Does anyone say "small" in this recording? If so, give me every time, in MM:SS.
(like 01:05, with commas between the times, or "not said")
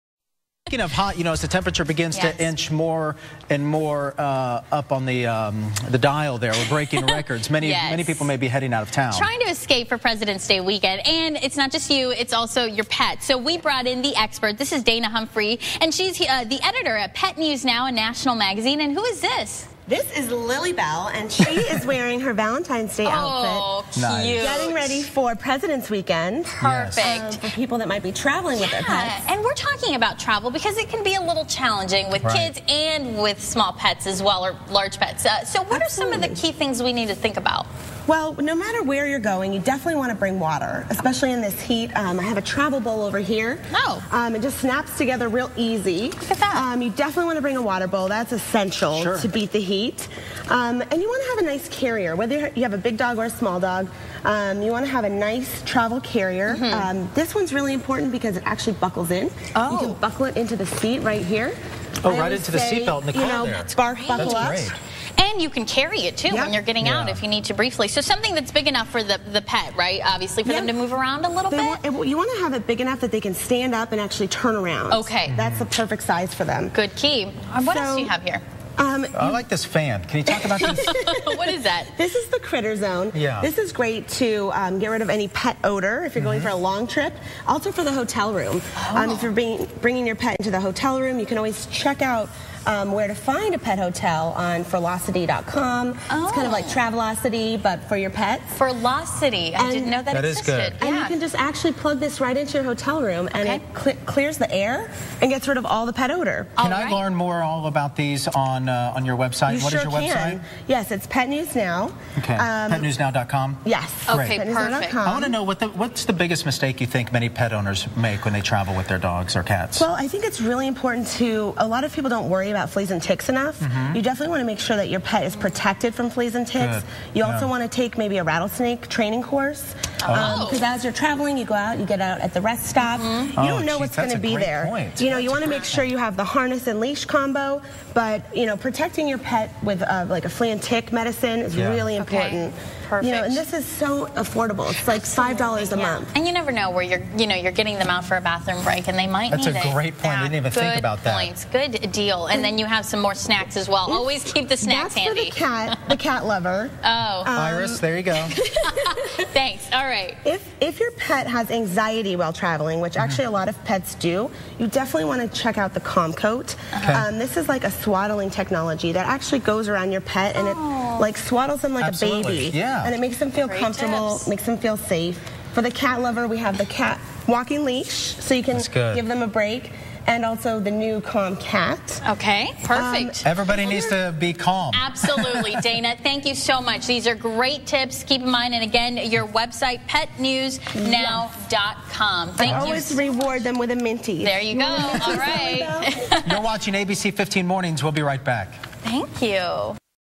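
00:33, 00:53.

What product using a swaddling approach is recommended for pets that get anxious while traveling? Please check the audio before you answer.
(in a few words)
Calm Coat.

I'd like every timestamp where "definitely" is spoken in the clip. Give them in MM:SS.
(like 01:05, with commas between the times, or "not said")
00:39, 00:46, 02:04, 02:44.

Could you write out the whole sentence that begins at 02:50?
it like swaddles them like Absolutely.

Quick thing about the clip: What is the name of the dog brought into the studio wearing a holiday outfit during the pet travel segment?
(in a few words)
Lily Bell.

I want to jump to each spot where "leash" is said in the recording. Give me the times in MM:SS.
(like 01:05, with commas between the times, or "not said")
02:16, 02:57.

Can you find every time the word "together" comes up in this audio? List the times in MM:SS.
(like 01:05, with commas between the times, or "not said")
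00:44.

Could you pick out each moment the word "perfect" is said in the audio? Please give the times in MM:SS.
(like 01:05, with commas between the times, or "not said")
00:26, 01:15, 01:54, 02:22, 03:02.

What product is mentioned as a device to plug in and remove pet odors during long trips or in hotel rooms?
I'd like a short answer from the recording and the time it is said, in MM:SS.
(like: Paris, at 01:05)
CritterZone, at 01:22.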